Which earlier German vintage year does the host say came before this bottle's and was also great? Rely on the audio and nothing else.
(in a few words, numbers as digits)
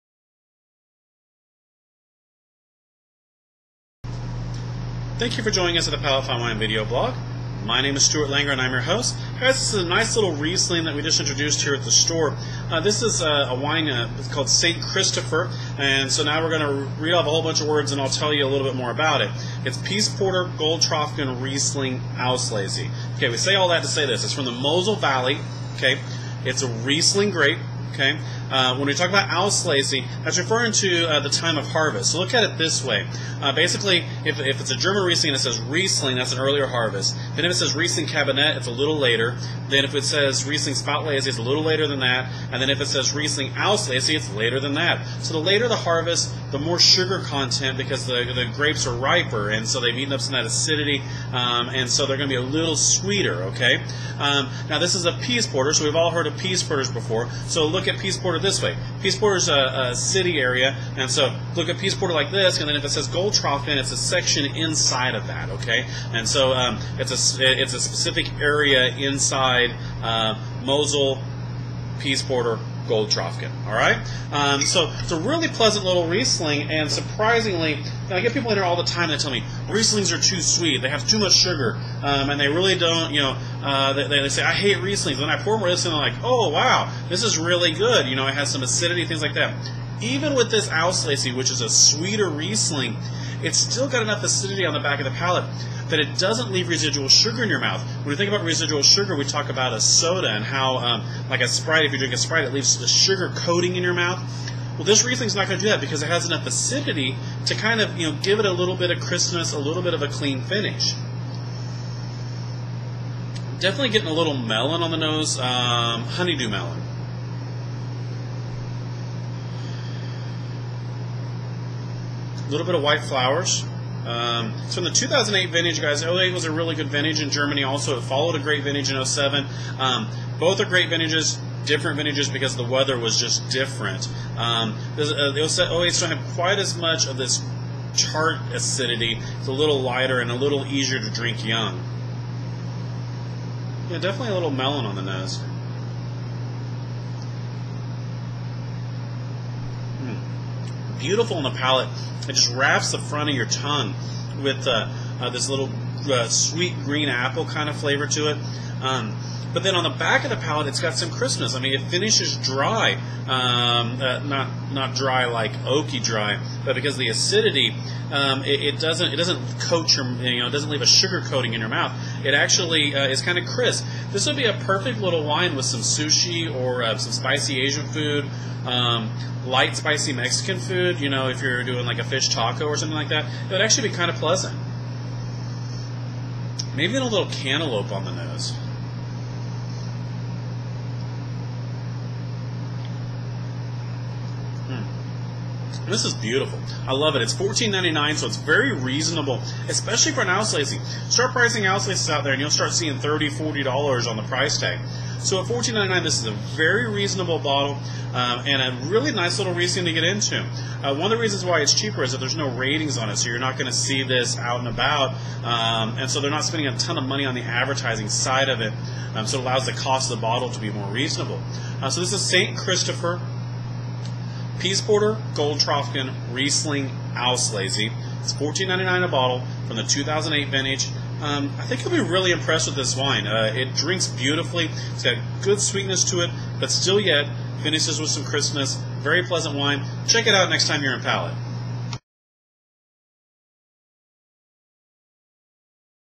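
2007.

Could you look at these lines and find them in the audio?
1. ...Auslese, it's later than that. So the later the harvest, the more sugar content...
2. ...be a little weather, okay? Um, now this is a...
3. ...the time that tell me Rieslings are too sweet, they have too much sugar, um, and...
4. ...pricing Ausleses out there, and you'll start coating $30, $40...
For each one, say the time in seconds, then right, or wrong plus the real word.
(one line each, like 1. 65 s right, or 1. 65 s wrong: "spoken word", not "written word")
1. 43 s right
2. 52 s wrong: "sweeter", not "weather"
3. 78 s right
4. 201 s wrong: "seeing", not "coating".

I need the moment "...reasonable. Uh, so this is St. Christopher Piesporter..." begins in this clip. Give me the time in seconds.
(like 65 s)
220 s.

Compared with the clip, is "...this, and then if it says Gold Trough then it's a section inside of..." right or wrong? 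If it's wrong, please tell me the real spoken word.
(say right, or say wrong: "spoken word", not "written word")
right.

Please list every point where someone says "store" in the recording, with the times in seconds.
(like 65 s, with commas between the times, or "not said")
11 s.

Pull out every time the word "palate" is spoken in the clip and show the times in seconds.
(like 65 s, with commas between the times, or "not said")
5 s, 95 s, 151 s, 160 s, 241 s.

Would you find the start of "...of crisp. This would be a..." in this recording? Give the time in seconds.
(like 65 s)
173 s.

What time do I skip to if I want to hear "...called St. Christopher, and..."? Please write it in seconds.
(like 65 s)
14 s.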